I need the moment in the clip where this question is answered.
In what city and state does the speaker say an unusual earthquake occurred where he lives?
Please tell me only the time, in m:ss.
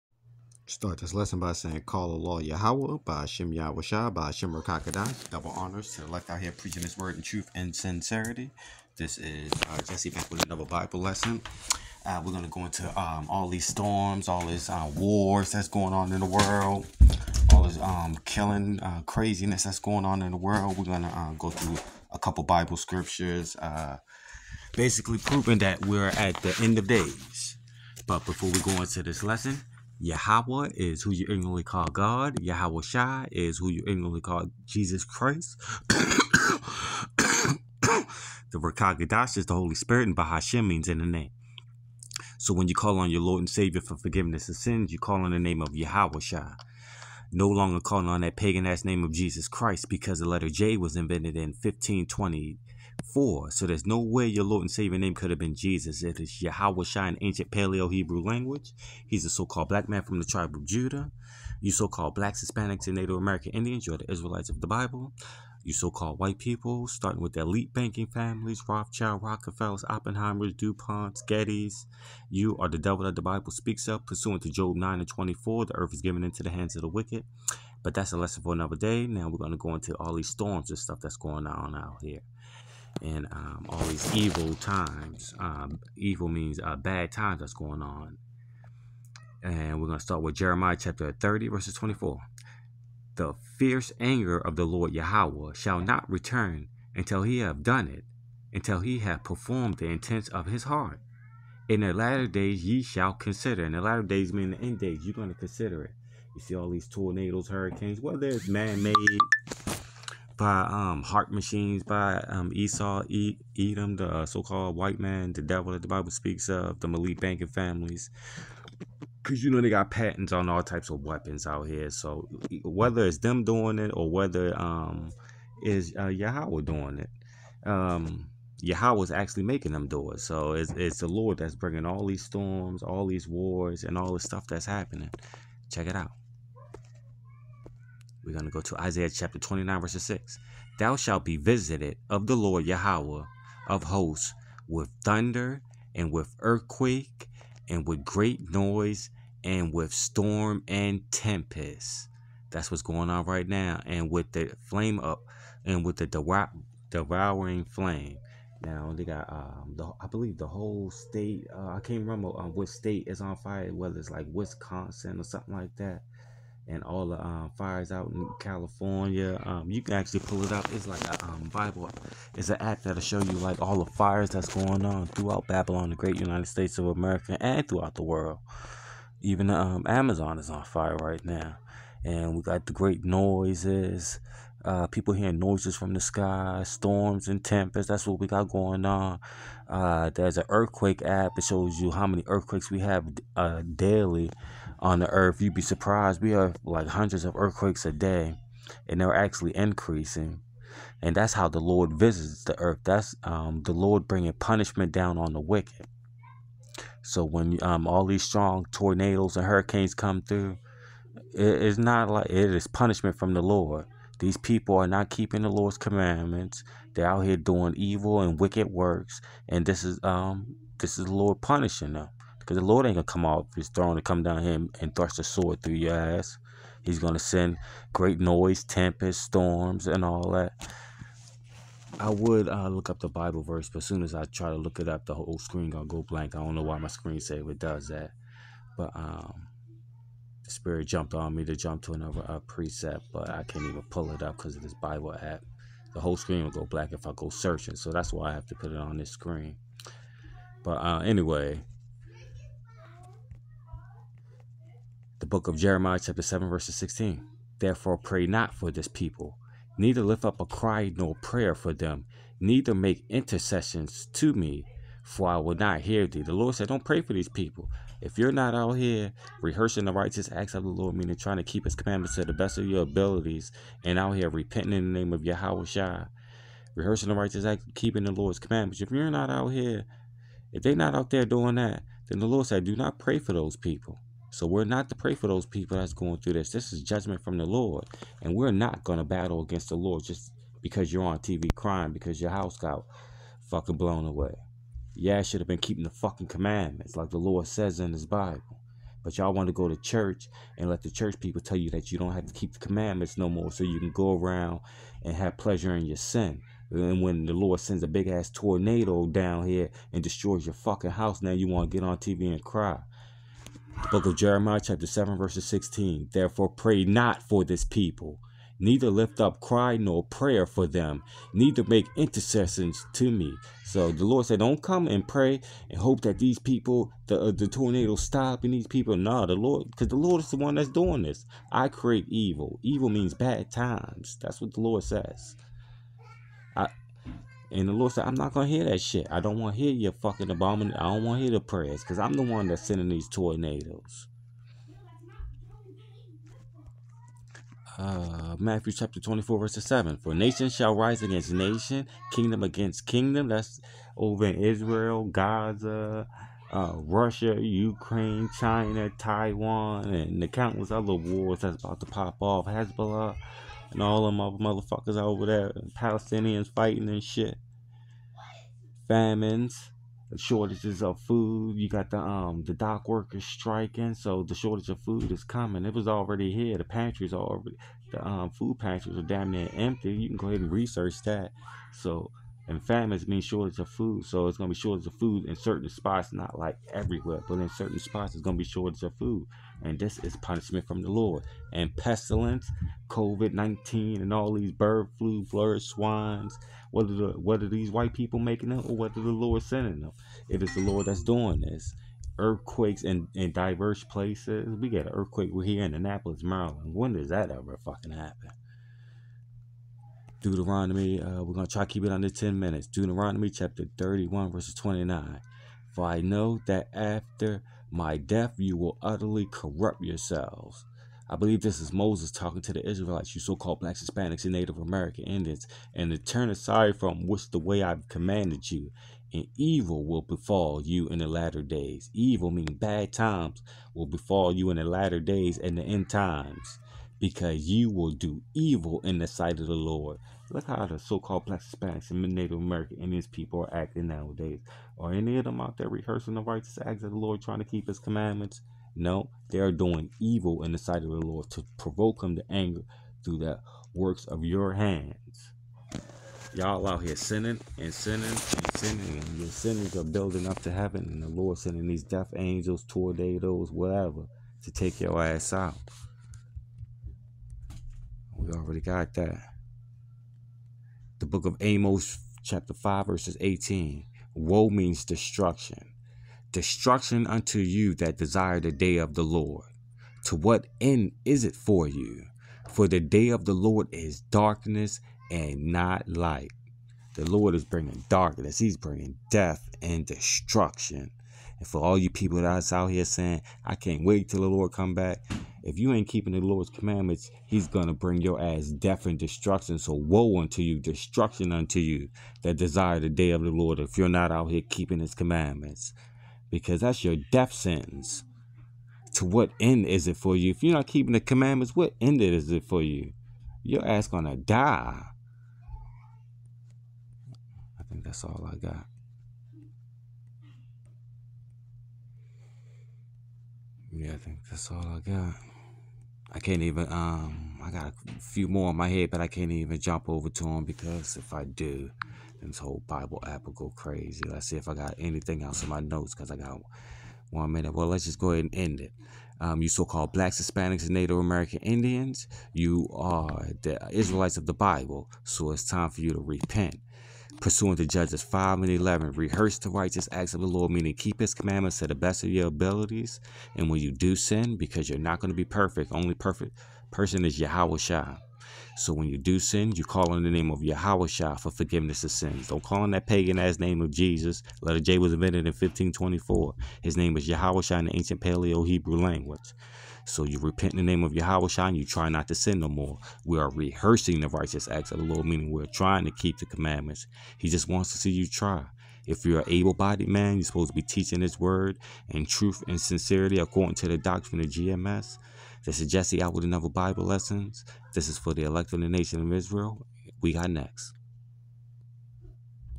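6:45.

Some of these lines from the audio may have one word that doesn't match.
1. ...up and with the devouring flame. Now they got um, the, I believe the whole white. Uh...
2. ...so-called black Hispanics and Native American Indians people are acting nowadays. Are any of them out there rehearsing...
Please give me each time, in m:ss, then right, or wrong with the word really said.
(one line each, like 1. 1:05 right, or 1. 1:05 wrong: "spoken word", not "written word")
1. 2:34 wrong: "state", not "white"
2. 7:20 right.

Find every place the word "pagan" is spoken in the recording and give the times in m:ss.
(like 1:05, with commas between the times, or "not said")
0:48, 9:22.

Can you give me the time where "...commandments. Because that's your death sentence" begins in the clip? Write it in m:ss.
8:24.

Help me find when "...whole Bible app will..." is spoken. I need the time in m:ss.
8:52.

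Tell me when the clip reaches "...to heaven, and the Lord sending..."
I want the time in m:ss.
7:40.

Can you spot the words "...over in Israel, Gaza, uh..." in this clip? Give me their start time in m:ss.
5:53.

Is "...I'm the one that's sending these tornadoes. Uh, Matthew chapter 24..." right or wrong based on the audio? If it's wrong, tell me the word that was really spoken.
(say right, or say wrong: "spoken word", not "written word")
right.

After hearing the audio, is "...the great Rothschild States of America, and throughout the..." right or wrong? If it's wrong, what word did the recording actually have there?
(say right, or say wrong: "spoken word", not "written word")
wrong: "United", not "Rothschild".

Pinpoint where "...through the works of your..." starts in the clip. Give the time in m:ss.
7:33.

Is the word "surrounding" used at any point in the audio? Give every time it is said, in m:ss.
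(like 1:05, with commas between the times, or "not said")
not said.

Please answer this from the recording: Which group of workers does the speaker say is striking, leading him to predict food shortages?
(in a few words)
Dock workers.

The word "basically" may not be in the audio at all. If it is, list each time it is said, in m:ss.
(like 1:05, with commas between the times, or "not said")
0:24.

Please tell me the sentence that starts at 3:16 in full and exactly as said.
We have like hundreds of earthquakes a day, and they're actually increasing.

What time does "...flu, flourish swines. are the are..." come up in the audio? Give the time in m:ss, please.
6:34.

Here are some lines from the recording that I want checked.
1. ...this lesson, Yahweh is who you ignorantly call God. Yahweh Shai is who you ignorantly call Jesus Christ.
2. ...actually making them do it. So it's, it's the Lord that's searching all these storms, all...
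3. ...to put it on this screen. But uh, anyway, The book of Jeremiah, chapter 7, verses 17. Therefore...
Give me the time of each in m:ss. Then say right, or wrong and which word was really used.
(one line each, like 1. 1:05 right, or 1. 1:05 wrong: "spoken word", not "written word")
1. 0:29 right
2. 2:09 wrong: "bringing", not "searching"
3. 4:08 wrong: "16", not "17".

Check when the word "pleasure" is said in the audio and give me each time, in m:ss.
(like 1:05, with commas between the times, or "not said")
5:05.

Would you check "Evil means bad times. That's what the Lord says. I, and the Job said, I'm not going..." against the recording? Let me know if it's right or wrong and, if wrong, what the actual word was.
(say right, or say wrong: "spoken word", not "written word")
wrong: "Lord", not "Job".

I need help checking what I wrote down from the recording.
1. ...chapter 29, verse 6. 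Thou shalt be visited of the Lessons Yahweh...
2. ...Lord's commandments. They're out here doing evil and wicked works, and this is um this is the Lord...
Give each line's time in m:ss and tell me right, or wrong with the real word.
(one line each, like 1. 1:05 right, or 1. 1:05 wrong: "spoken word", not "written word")
1. 2:19 wrong: "Lord", not "Lessons"
2. 3:35 right.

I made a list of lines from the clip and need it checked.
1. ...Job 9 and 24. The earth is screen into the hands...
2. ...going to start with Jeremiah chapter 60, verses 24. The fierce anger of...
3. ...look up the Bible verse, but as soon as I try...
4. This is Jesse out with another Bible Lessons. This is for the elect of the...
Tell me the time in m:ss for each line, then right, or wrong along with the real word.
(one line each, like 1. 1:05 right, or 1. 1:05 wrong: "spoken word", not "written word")
1. 1:14 wrong: "given", not "screen"
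2. 1:29 wrong: "30", not "60"
3. 3:52 right
4. 9:45 right.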